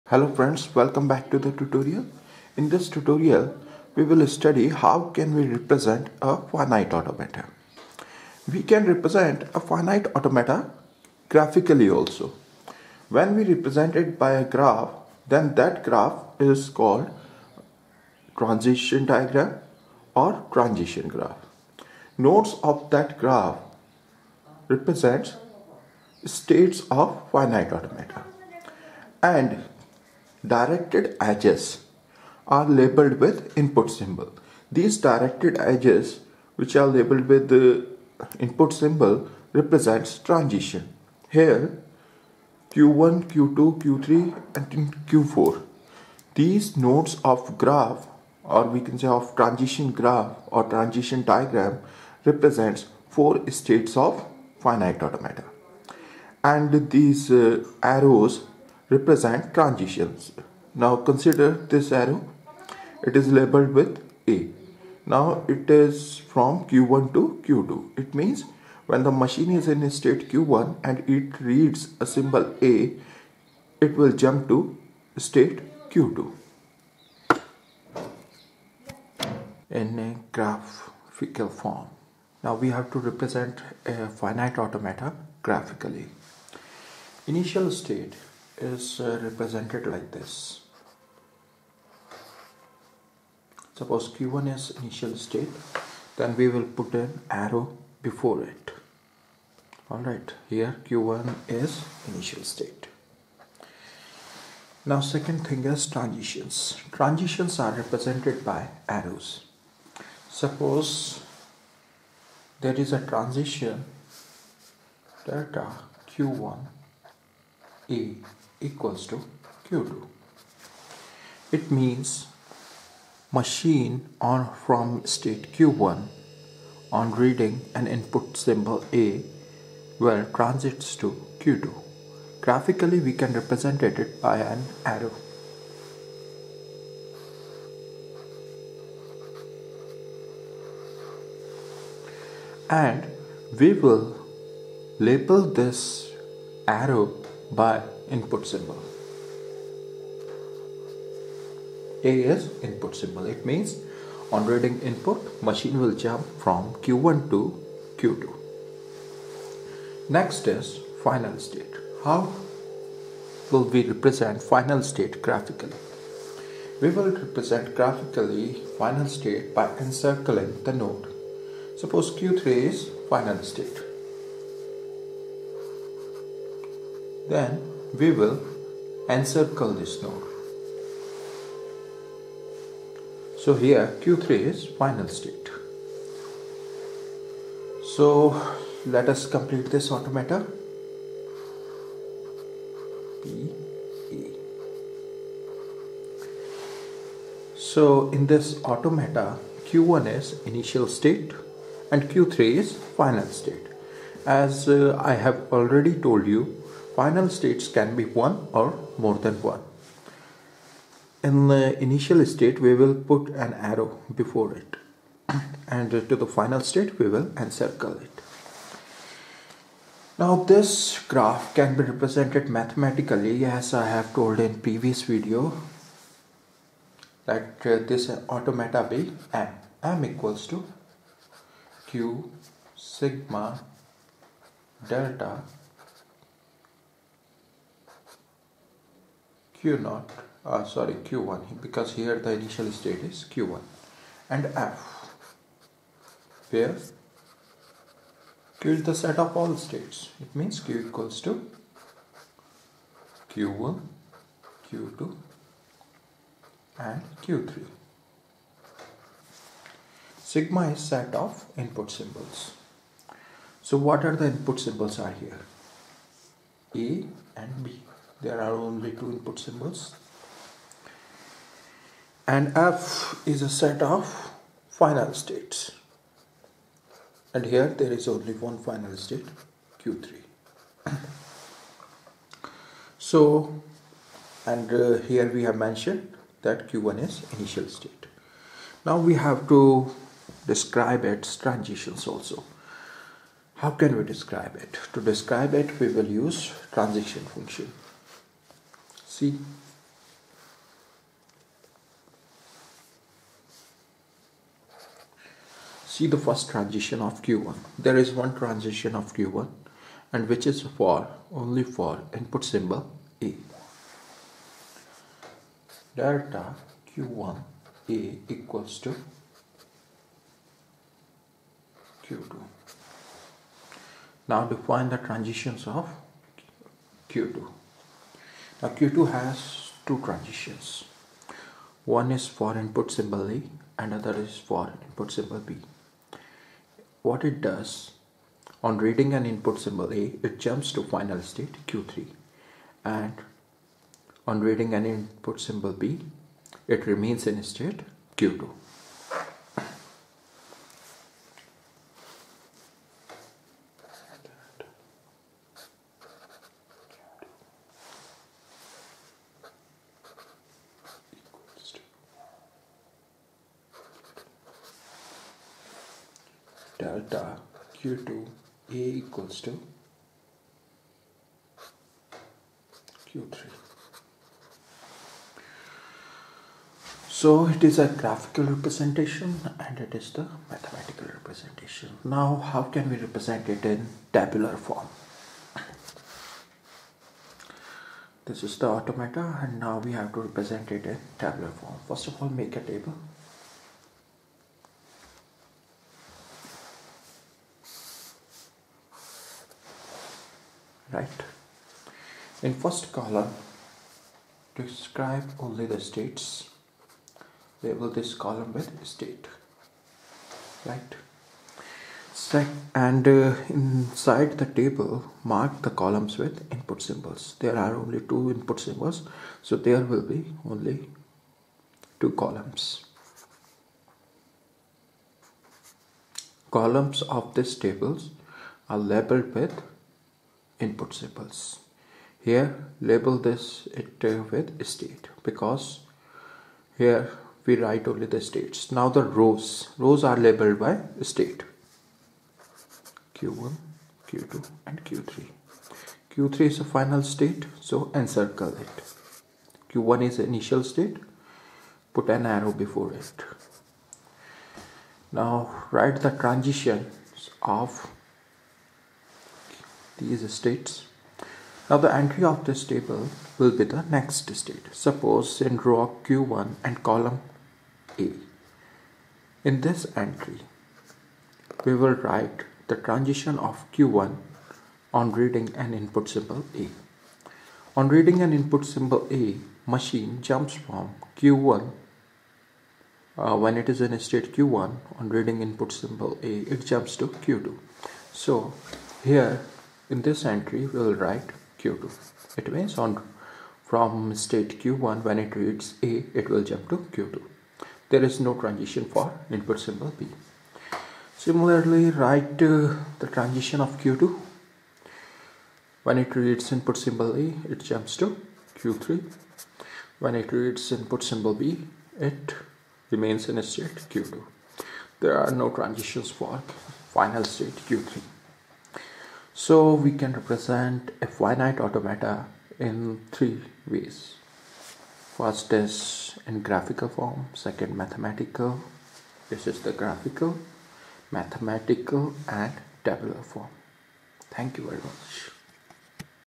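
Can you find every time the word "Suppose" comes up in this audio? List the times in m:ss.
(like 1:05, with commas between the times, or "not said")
1:33, 1:50, 2:51, 7:44.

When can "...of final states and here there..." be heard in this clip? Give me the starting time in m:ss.
4:33.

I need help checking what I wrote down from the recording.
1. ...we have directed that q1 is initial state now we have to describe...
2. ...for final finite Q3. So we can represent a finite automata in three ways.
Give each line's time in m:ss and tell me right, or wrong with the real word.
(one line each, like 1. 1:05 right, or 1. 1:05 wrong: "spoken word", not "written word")
1. 4:45 wrong: "mentioned", not "directed"
2. 8:36 wrong: "state", not "finite".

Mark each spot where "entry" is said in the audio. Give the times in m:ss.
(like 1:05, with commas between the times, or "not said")
7:41, 7:49, 8:10.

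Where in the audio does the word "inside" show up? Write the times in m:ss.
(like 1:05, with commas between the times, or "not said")
6:53.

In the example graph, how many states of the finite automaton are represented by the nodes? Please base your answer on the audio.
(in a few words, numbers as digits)
4.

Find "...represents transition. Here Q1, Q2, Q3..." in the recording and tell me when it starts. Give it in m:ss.
0:39.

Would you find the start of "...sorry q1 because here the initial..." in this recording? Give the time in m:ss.
4:00.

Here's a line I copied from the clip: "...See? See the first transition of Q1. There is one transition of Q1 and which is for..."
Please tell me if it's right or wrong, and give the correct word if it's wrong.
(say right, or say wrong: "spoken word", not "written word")
right.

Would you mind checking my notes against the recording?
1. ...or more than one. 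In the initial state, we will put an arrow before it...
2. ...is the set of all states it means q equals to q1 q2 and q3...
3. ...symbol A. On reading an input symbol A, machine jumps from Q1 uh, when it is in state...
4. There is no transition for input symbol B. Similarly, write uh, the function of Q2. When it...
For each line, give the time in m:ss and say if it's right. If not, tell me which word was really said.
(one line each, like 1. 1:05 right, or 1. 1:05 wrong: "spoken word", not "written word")
1. 3:28 right
2. 4:08 right
3. 7:56 right
4. 8:17 wrong: "transition", not "function".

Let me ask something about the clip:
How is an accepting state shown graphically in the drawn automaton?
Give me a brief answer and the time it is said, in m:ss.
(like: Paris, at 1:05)
Encircling the node, at 2:49.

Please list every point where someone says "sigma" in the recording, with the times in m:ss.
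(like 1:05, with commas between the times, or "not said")
3:52, 4:20.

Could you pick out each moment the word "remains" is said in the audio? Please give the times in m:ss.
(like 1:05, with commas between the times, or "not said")
5:46, 8:32.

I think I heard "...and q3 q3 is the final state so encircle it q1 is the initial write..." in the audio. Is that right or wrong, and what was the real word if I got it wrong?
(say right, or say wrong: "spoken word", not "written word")
wrong: "state", not "write".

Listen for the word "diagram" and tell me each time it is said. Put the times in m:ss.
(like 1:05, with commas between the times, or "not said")
0:19, 0:51.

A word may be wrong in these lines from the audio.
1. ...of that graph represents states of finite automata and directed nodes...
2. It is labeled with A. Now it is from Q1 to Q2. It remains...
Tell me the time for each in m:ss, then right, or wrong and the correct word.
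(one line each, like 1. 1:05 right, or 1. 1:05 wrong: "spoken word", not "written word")
1. 0:22 wrong: "edges", not "nodes"
2. 1:03 wrong: "means", not "remains".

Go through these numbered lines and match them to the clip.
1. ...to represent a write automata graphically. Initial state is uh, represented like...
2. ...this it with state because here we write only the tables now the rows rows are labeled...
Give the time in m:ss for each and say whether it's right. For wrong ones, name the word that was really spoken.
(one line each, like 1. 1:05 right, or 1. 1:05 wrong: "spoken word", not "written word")
1. 1:22 wrong: "finite", not "write"
2. 7:13 wrong: "states", not "tables".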